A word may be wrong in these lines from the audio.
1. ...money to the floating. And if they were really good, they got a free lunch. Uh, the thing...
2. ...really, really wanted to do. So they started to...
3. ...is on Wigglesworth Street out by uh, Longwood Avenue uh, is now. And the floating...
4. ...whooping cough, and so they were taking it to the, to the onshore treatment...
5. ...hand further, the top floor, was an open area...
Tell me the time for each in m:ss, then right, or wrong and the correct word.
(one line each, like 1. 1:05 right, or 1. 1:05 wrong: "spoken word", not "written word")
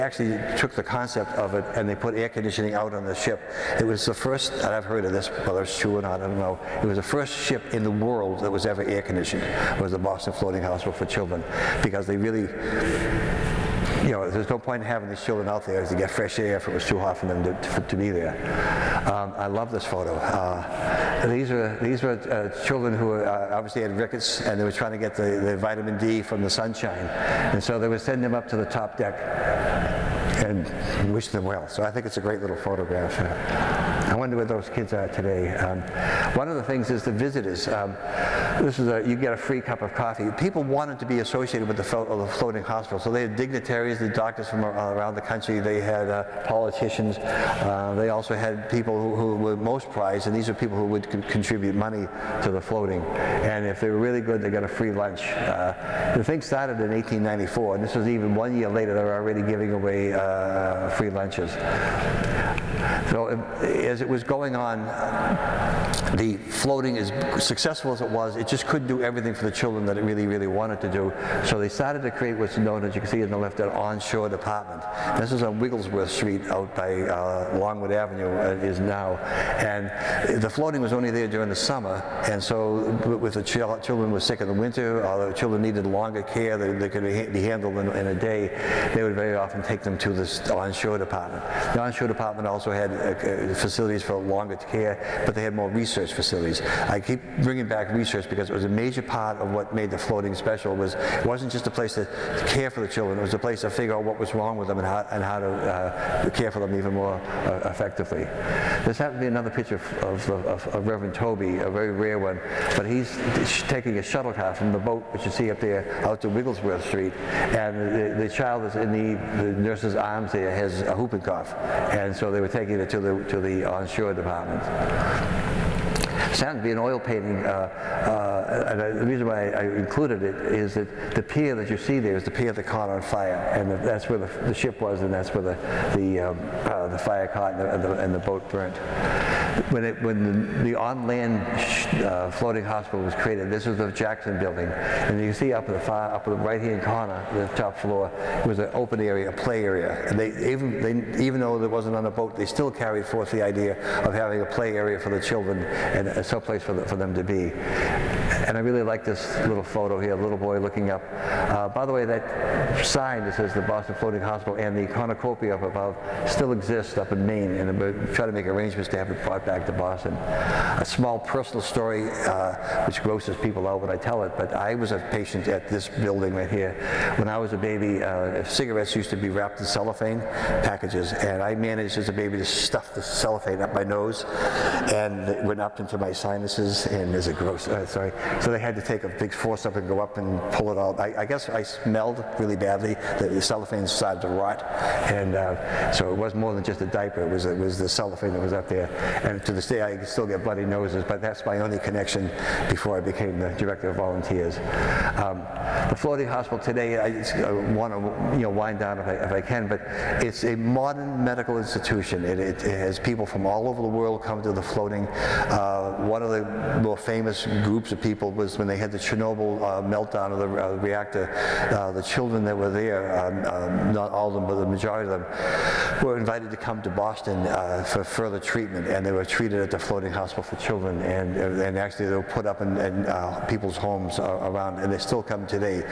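1. 0:51 right
2. 1:10 right
3. 1:15 right
4. 2:00 wrong: "department", not "treatment"
5. 2:26 wrong: "corner", not "further".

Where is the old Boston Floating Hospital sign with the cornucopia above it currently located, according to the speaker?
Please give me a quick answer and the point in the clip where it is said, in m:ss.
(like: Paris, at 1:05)
Maine, at 2:47.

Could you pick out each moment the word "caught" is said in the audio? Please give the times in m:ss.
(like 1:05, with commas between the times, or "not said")
2:12, 2:17.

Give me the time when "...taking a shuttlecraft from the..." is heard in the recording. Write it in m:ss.
1:53.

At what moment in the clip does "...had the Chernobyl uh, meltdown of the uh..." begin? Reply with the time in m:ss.
3:38.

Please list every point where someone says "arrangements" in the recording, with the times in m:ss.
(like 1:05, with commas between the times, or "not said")
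2:48.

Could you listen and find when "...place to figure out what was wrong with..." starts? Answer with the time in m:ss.
1:43.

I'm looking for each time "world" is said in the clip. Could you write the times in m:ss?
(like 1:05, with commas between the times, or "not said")
0:07, 3:33.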